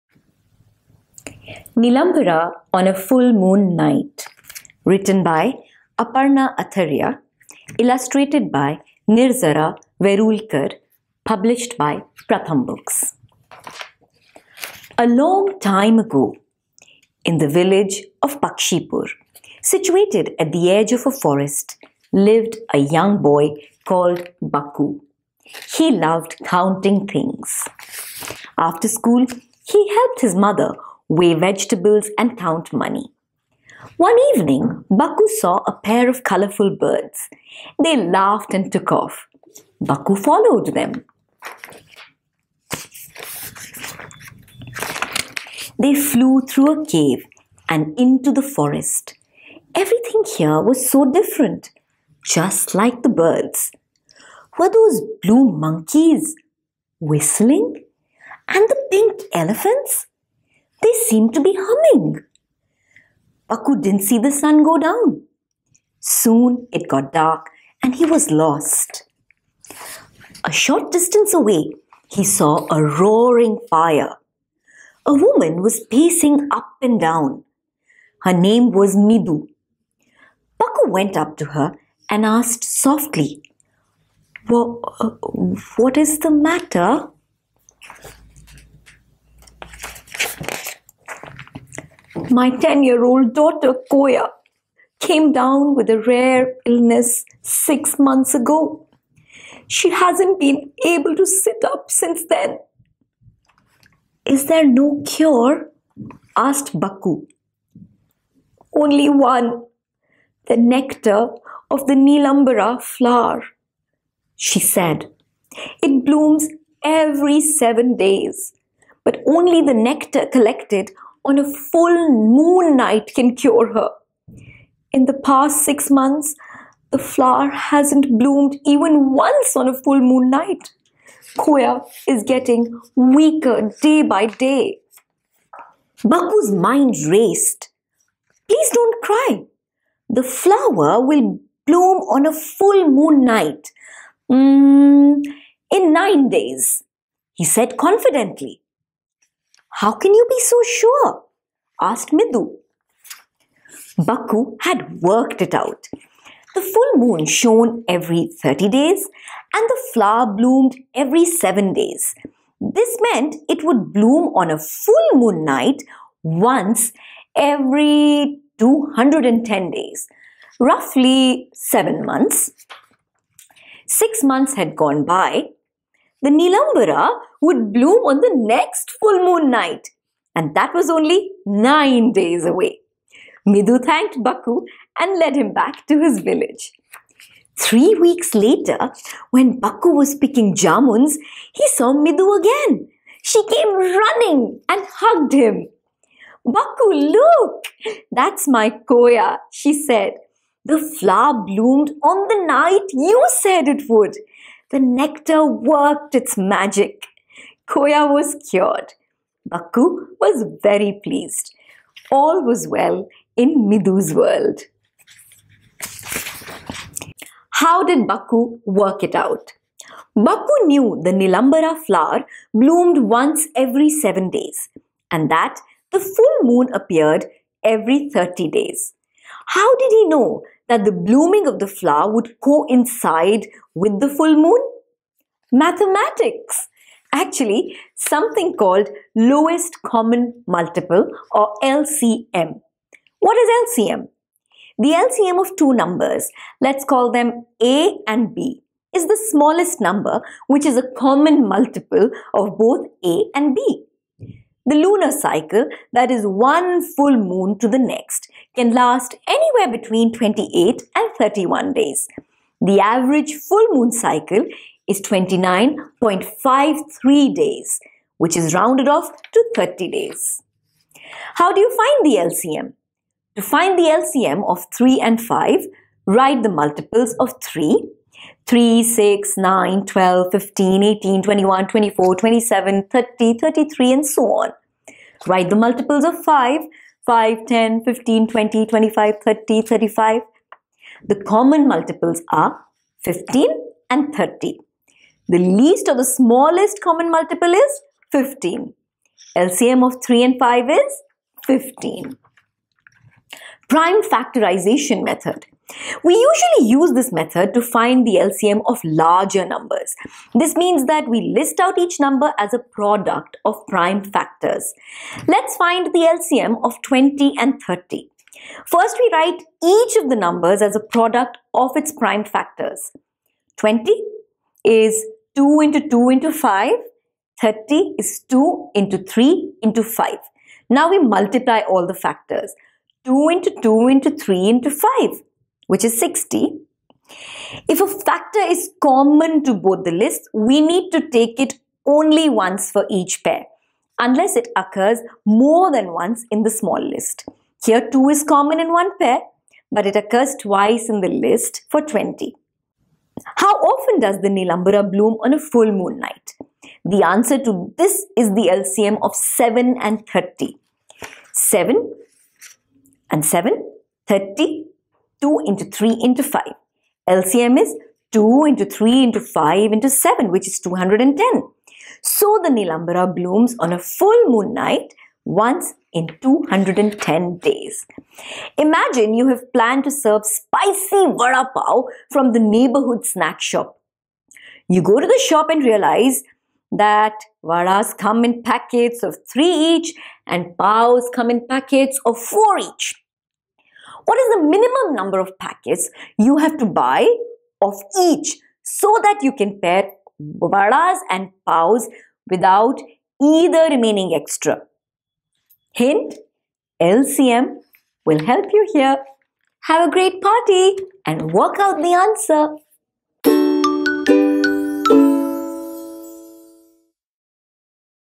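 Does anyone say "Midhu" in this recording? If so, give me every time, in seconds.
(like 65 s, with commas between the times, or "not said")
183 s, 191 s.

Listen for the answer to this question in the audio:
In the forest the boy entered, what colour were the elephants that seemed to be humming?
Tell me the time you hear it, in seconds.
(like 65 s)
58 s.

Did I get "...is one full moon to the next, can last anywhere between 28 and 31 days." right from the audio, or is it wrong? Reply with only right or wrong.
right.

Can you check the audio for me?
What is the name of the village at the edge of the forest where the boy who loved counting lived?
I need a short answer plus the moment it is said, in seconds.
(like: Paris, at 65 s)
Pakshipur, at 18 s.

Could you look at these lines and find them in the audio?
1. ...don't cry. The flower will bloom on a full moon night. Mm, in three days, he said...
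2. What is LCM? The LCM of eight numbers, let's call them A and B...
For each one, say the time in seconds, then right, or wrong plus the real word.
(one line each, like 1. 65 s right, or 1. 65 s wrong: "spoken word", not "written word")
1. 138 s wrong: "nine", not "three"
2. 243 s wrong: "two", not "eight".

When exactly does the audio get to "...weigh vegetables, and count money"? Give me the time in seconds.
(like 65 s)
31 s.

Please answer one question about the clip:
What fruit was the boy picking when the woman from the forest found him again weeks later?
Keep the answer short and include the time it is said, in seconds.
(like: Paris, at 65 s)
jamuns, at 190 s.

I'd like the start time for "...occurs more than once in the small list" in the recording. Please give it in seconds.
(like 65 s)
344 s.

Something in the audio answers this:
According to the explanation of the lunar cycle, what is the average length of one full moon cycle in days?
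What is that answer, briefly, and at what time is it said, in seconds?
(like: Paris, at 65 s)
29.53, at 265 s.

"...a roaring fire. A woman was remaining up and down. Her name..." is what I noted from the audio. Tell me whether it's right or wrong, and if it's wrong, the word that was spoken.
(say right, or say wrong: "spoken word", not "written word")
wrong: "pacing", not "remaining".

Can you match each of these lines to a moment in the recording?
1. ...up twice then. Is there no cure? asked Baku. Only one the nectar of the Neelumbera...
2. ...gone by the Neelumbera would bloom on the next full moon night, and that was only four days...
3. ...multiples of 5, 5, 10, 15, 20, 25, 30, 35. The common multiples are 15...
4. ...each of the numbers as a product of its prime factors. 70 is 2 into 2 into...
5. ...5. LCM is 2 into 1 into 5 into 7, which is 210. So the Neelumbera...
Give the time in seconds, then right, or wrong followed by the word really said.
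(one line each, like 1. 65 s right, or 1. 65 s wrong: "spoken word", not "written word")
1. 101 s wrong: "since", not "twice"
2. 174 s wrong: "nine", not "four"
3. 285 s right
4. 319 s wrong: "20", not "70"
5. 366 s wrong: "3", not "1".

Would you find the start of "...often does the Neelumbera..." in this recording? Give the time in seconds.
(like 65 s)
353 s.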